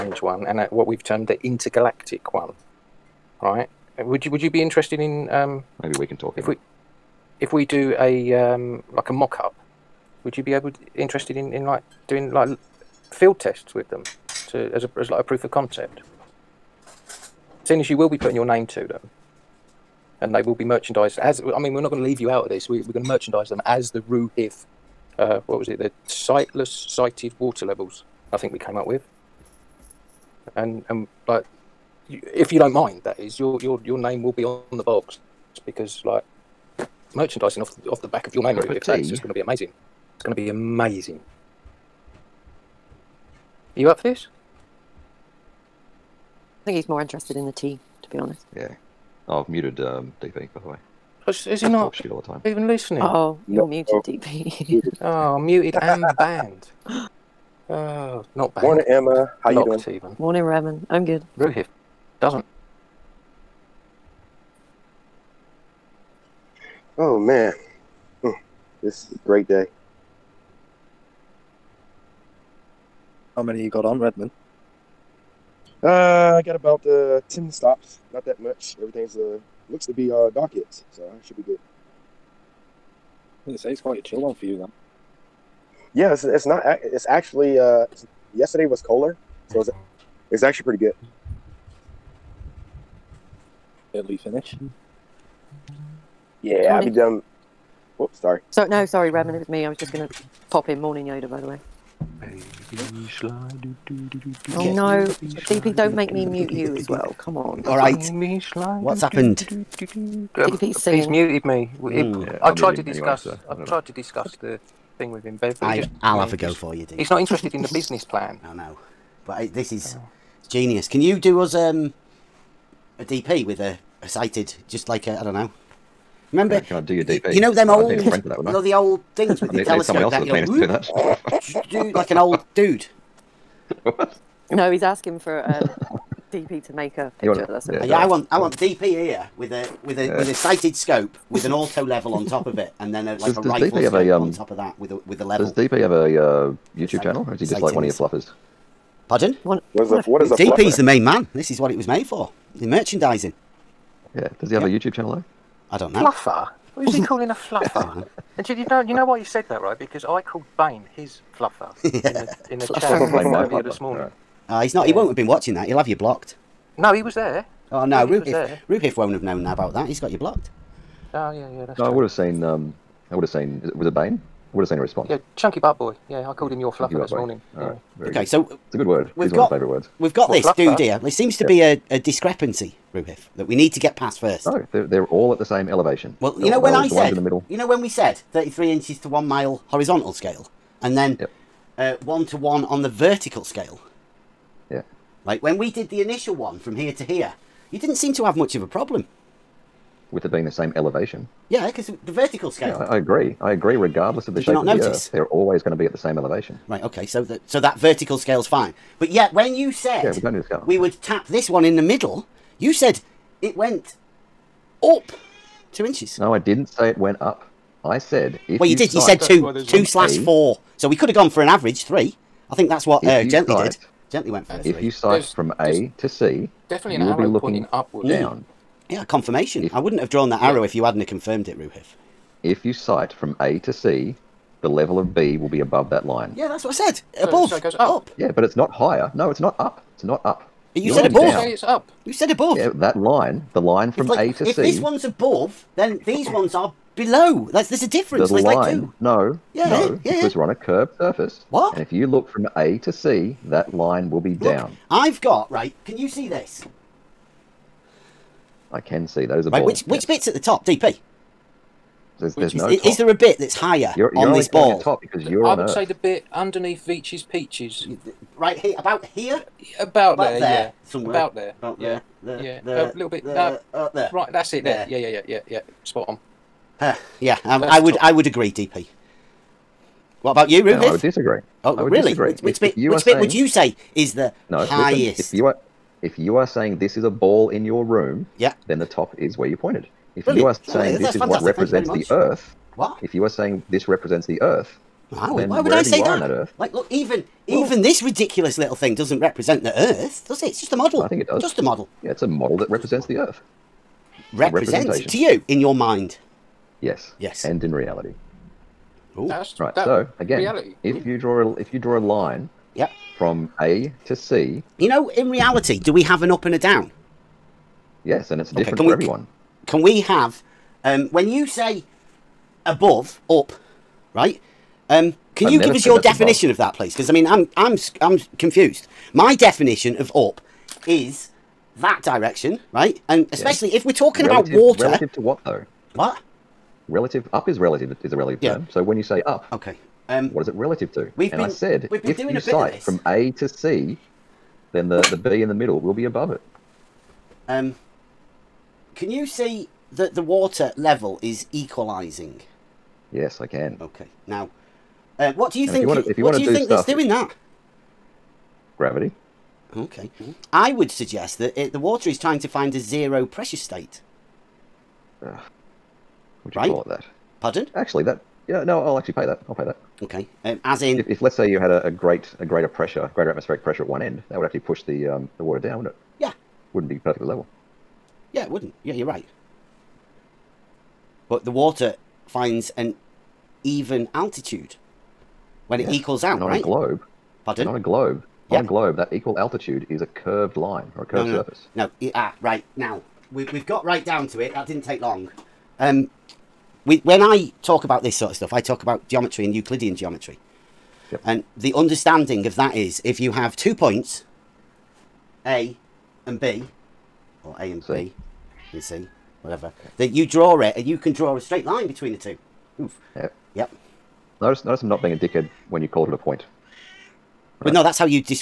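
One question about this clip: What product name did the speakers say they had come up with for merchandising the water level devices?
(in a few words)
sightless sighted water levels.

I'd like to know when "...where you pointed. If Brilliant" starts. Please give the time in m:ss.
4:49.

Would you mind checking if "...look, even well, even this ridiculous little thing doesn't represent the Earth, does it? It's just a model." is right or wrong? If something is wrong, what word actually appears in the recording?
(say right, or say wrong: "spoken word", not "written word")
right.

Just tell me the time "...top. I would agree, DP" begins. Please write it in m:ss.
4:37.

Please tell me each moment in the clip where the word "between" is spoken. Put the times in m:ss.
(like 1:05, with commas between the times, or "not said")
6:51.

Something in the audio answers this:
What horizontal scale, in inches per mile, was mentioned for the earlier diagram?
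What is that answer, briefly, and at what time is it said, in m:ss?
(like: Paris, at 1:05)
33 inches to one mile, at 3:08.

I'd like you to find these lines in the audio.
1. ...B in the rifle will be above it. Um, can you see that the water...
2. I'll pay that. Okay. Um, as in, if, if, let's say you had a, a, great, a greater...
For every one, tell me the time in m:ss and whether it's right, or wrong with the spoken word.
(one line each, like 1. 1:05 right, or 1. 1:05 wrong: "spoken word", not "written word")
1. 5:45 wrong: "middle", not "rifle"
2. 6:09 right.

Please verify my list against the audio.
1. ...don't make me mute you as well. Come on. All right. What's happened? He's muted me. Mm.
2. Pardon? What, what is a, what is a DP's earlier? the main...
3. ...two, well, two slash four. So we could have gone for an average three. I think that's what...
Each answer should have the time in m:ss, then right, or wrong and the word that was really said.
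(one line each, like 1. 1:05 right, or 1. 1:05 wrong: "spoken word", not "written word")
1. 1:45 right
2. 2:29 wrong: "fluffer", not "earlier"
3. 3:39 right.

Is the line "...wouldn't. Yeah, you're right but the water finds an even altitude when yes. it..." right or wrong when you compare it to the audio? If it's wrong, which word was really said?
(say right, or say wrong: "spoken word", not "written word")
right.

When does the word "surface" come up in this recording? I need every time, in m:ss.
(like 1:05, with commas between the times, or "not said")
4:10, 6:31.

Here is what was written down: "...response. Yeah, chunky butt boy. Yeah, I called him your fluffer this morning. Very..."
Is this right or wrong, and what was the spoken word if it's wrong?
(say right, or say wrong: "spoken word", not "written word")
right.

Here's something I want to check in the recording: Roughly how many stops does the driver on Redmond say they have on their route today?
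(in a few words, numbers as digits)
10.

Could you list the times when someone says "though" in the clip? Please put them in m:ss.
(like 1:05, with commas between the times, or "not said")
2:35, 5:35.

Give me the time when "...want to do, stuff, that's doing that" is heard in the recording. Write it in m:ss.
5:56.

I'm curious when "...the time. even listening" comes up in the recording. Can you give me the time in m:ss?
0:52.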